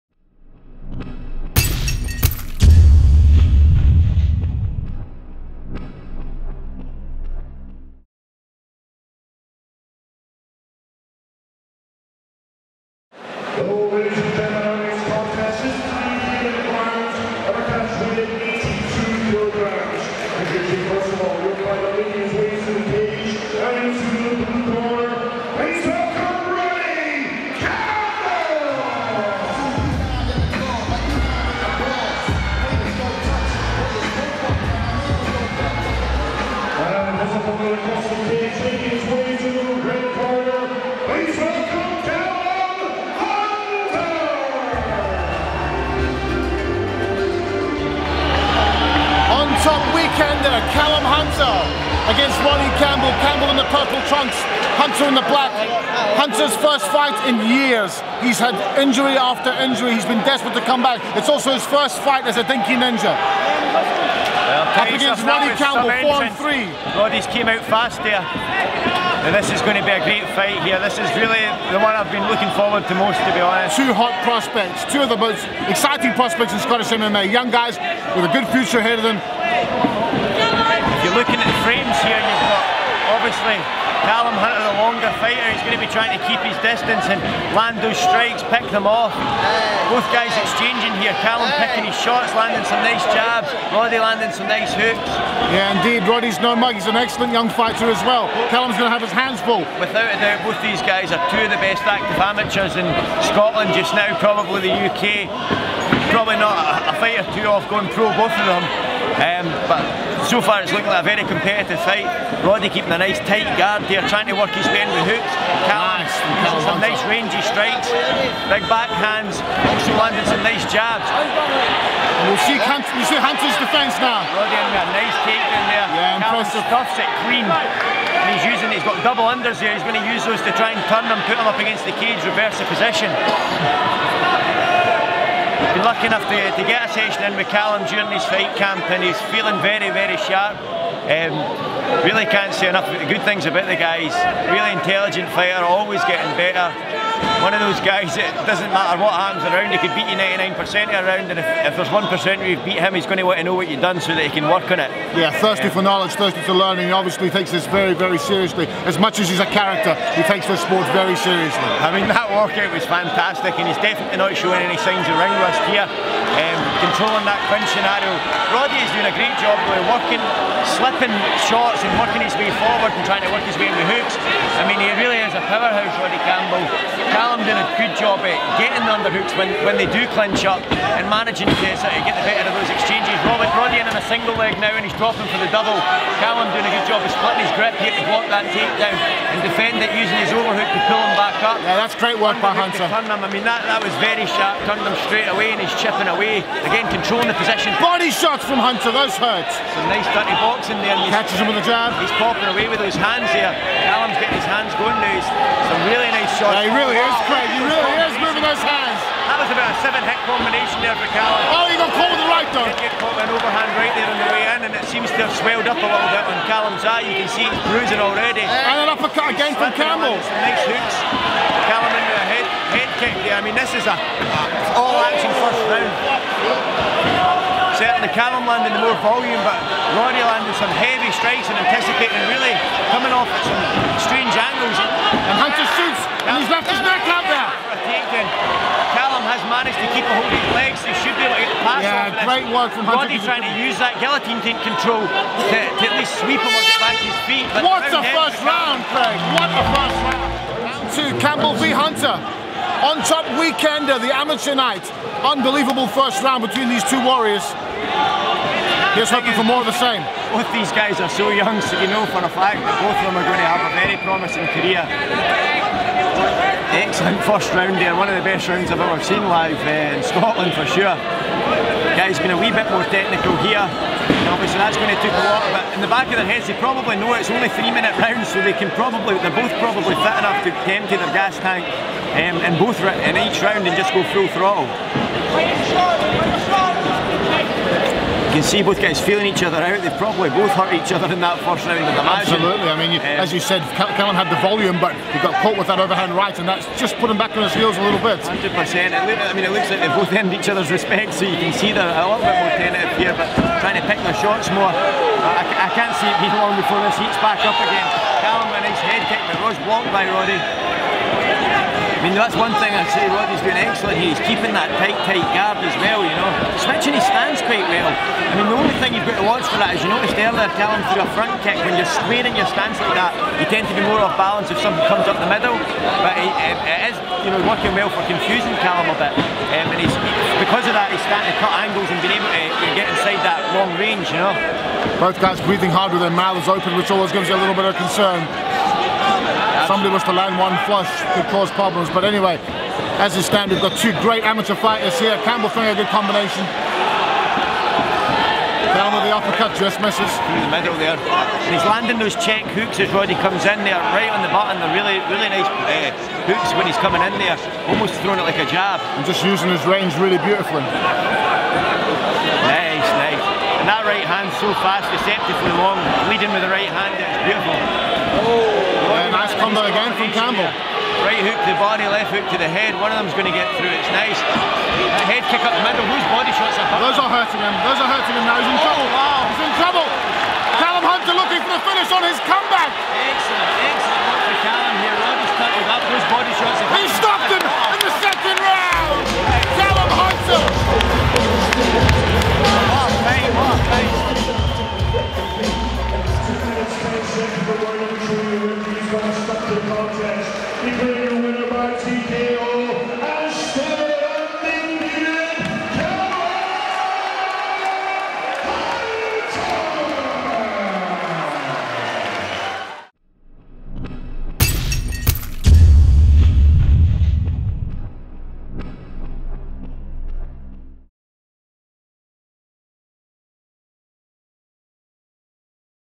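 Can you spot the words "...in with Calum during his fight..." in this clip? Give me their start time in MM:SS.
02:17.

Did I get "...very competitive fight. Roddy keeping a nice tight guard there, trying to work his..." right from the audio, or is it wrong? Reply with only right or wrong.
right.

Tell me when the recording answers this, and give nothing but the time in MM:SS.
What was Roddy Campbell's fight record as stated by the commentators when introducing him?
01:06.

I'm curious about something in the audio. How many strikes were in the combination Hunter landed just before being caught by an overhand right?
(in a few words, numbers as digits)
7.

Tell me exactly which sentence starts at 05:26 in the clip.
But it, it, it is, you know, working well for confusing Calum a bit.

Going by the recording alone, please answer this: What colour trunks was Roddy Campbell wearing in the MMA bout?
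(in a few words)
Purple.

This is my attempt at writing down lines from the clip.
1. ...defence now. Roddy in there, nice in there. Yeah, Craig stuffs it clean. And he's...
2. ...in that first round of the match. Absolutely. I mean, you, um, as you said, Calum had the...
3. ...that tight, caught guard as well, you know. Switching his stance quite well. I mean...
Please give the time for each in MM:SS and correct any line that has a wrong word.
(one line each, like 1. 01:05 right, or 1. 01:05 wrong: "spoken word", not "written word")
1. 02:03 wrong: "Calum", not "Craig"
2. 04:51 right
3. 05:14 wrong: "tight", not "caught".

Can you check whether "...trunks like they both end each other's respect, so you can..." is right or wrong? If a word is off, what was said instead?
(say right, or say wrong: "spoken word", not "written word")
wrong: "looks", not "trunks".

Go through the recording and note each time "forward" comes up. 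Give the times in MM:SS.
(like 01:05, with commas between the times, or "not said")
01:12, 02:52.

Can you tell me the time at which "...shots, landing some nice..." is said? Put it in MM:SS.
01:32.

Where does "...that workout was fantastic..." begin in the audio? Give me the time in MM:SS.
02:42.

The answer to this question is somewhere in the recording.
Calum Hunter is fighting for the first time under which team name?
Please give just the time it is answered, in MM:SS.
01:02.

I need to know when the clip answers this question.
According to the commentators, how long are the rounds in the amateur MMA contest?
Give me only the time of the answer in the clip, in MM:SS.
04:37.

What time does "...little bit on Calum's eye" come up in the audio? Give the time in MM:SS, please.
03:35.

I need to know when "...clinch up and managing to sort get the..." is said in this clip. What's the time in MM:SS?
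03:00.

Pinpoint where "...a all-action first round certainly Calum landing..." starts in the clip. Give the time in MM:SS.
03:43.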